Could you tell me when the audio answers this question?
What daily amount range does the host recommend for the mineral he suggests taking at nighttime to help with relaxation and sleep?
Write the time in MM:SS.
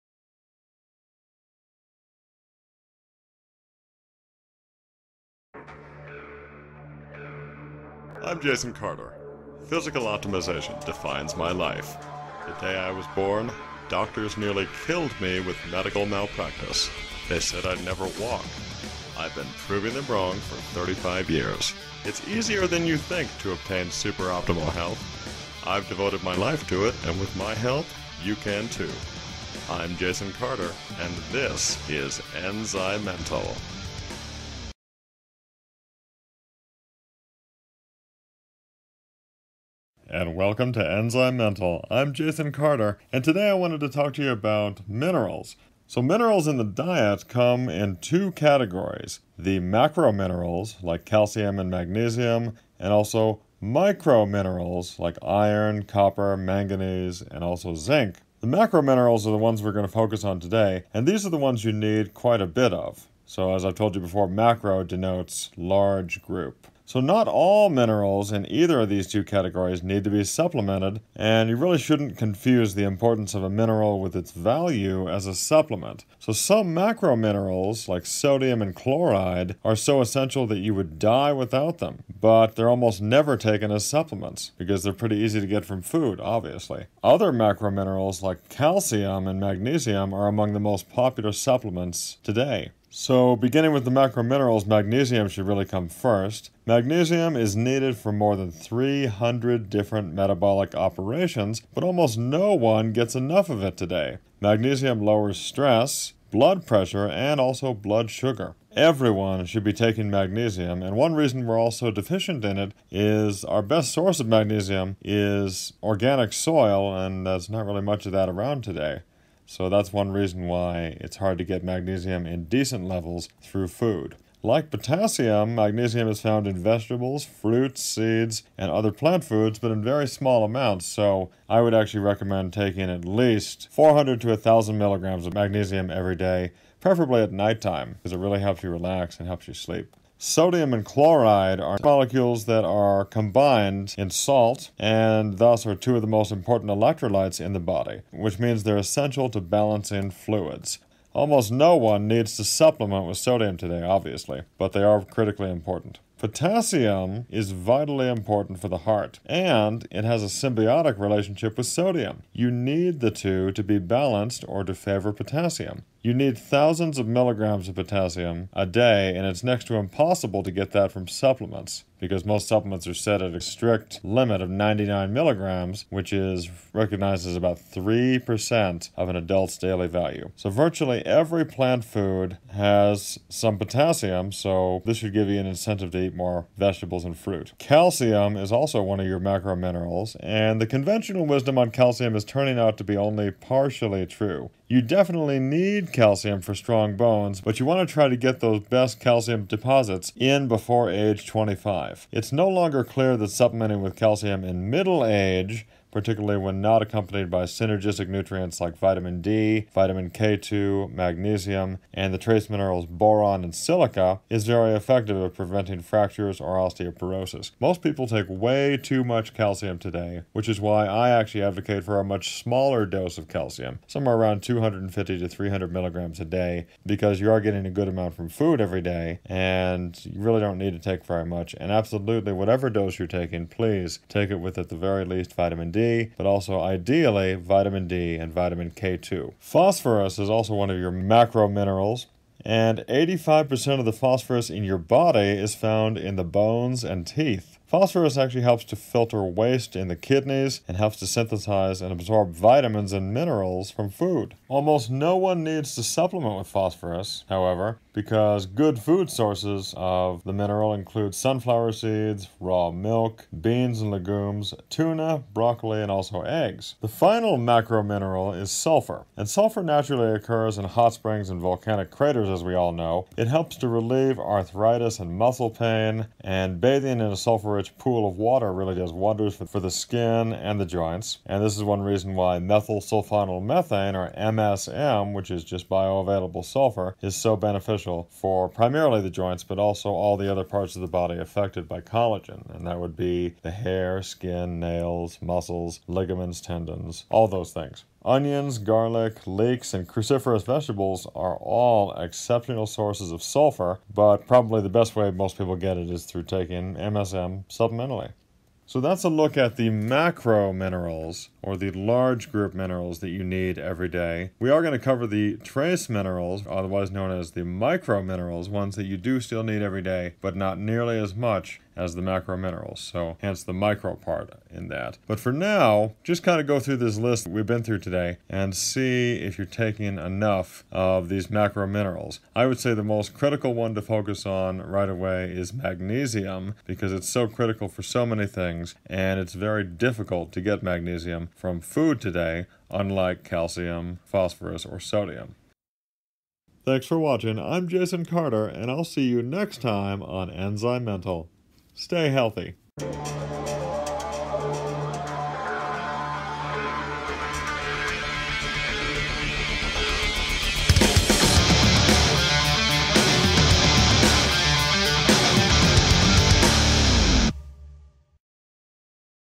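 02:13.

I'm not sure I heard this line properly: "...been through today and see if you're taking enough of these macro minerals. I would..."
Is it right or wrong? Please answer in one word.
right.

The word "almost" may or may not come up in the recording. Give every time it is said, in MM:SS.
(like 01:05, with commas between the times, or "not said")
01:22, 01:41, 02:31, 04:14.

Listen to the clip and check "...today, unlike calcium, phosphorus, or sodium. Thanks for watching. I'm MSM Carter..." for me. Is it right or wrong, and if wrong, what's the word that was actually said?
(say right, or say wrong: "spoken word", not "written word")
wrong: "Jason", not "MSM".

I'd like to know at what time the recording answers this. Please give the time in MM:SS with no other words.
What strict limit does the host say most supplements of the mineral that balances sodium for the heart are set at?
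02:54.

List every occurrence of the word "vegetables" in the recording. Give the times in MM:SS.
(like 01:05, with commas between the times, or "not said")
02:06, 03:06, 05:00.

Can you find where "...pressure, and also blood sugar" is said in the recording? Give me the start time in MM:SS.
01:46.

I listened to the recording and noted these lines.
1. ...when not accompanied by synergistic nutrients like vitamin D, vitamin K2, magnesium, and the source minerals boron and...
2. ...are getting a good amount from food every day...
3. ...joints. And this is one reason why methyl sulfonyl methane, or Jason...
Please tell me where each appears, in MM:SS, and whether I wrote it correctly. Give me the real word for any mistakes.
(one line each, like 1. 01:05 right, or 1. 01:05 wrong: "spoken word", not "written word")
1. 03:26 wrong: "trace", not "source"
2. 03:47 right
3. 04:40 wrong: "MSM", not "Jason".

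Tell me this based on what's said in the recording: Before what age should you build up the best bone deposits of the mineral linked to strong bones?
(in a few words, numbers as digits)
25.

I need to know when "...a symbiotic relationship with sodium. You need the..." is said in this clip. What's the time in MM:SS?
02:40.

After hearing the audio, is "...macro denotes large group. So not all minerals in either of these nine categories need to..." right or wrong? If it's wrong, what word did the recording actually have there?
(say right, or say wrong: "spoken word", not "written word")
wrong: "two", not "nine".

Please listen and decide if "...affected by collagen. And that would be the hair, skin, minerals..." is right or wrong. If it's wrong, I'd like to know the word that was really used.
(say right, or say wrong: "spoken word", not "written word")
wrong: "nails", not "minerals".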